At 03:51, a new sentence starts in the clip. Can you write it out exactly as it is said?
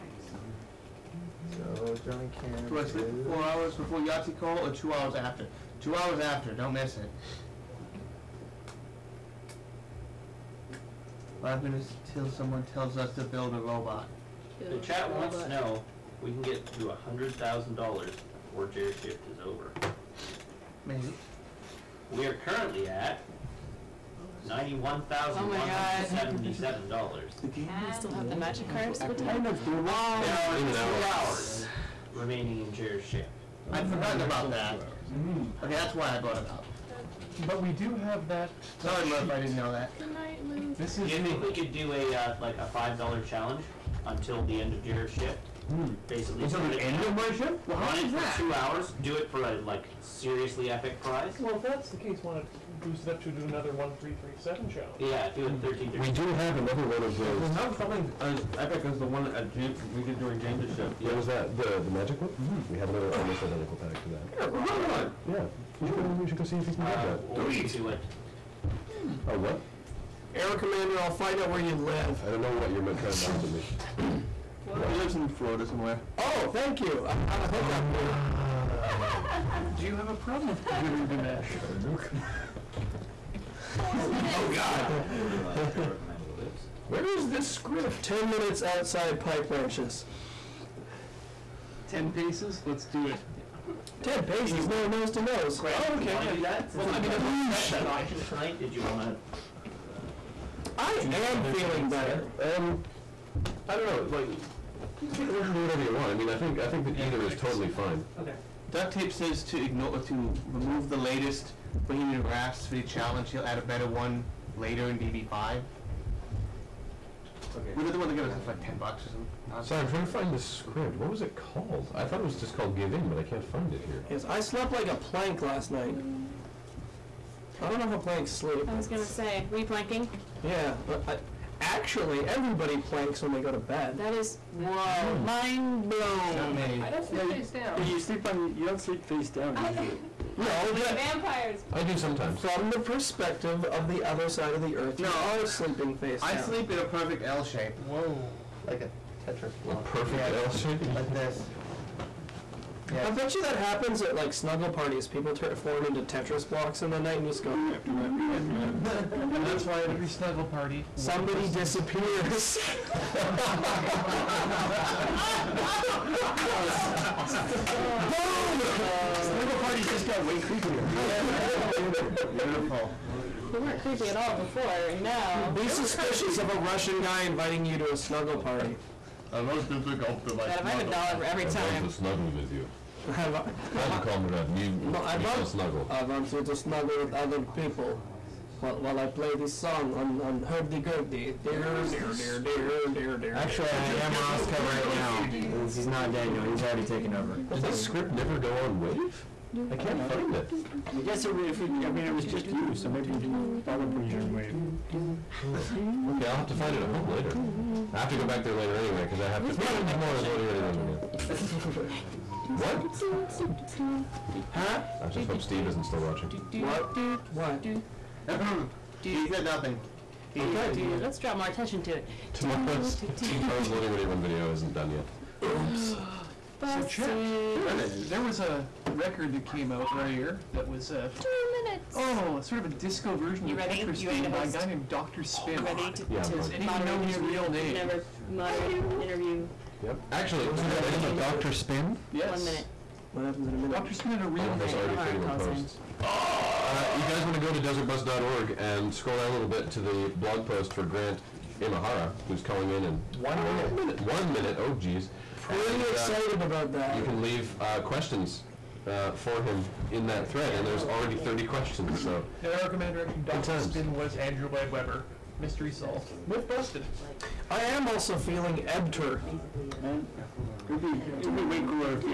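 Oh, sort of a disco version you of ready?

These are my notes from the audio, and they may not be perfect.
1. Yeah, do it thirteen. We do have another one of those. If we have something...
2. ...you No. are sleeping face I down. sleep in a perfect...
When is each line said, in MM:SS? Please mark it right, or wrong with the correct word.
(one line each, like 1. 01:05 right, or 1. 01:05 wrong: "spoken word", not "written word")
1. 00:54 right
2. 02:24 right.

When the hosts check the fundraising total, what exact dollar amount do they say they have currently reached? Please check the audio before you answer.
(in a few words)
$91,177.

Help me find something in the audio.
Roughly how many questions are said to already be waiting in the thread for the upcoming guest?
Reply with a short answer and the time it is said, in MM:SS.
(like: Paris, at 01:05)
30, at 04:21.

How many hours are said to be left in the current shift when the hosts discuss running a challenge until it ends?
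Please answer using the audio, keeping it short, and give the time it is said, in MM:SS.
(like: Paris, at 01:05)
2, at 00:30.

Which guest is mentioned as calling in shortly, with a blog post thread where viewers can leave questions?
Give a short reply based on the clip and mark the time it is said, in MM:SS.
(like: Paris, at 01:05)
Grant Imahara, at 04:10.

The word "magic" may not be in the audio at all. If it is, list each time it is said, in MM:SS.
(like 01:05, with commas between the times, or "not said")
00:28, 01:01.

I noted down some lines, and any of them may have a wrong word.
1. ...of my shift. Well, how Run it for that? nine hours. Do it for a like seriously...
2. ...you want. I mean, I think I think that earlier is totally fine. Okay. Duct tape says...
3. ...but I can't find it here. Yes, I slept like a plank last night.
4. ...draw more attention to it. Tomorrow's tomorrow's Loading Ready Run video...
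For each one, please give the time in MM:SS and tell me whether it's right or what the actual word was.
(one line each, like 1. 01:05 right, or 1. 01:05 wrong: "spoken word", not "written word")
1. 00:47 wrong: "two", not "nine"
2. 01:45 wrong: "either", not "earlier"
3. 02:03 right
4. 03:41 right.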